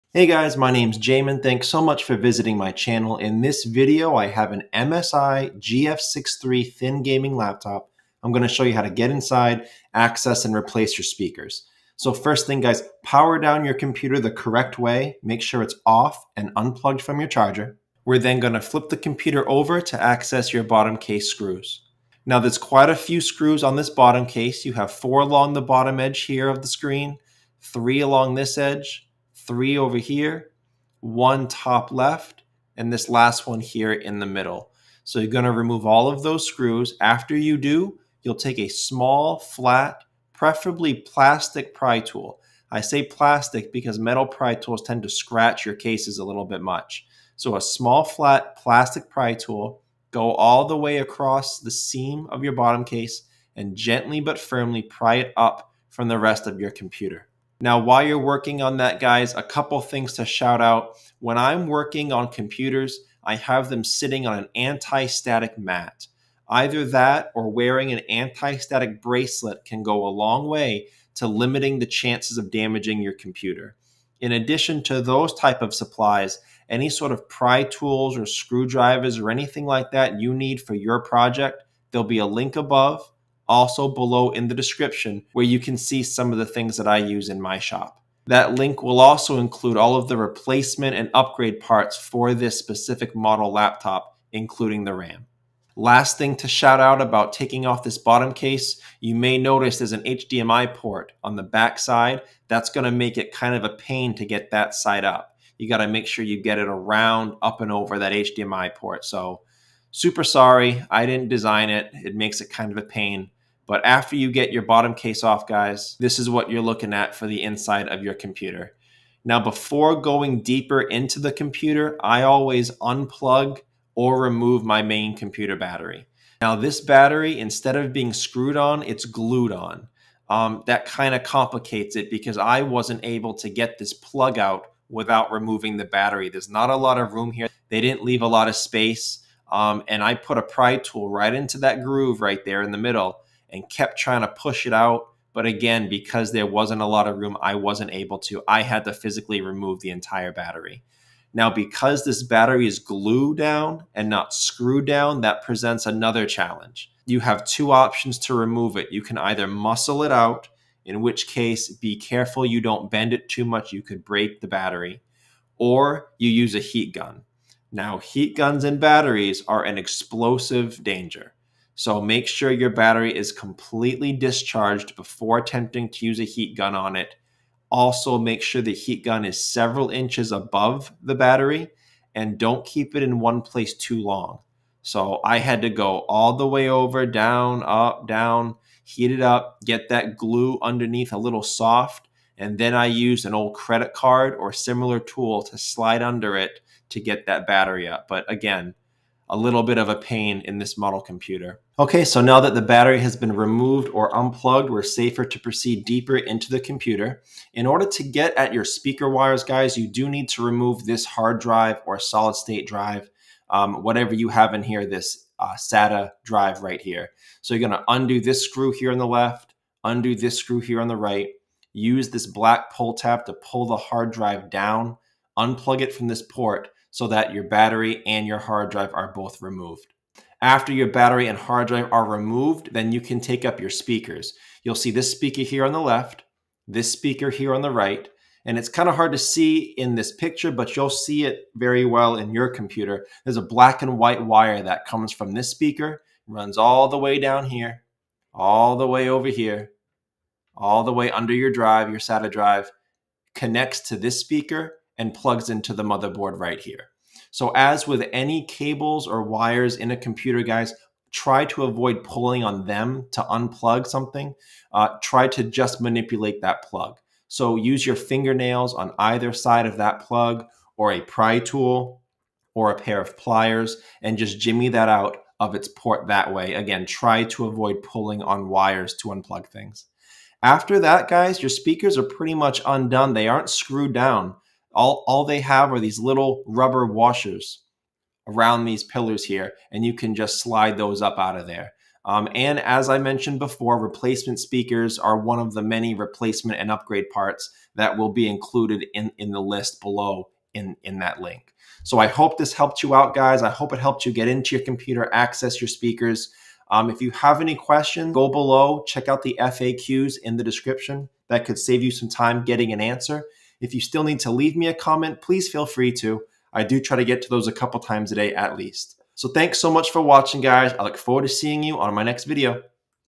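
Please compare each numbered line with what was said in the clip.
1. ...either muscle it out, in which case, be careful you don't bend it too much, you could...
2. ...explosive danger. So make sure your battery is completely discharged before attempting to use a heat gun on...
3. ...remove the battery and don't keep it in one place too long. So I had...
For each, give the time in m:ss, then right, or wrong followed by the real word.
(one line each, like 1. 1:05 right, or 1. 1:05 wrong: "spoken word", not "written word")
1. 2:39 right
2. 2:49 right
3. 3:00 wrong: "above", not "remove".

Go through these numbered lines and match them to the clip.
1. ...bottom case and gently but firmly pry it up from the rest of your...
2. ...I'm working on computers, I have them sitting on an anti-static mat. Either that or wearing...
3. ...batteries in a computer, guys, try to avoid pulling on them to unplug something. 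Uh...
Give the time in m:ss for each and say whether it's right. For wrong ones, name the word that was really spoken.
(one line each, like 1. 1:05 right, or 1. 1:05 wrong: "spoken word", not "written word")
1. 0:52 right
2. 1:01 right
3. 4:19 wrong: "wires", not "batteries".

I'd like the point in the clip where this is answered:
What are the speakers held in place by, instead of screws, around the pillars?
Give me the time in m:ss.
4:46.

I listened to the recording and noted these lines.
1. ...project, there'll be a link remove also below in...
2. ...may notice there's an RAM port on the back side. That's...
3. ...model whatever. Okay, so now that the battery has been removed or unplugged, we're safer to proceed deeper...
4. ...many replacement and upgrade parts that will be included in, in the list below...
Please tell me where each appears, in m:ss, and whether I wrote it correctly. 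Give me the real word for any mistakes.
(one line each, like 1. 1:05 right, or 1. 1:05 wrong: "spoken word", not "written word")
1. 1:21 wrong: "above", not "remove"
2. 1:39 wrong: "HDMI", not "RAM"
3. 3:20 wrong: "computer", not "whatever"
4. 4:55 right.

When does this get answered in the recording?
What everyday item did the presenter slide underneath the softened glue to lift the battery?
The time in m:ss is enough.
3:13.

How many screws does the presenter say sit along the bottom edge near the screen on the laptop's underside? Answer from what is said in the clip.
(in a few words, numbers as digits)
4.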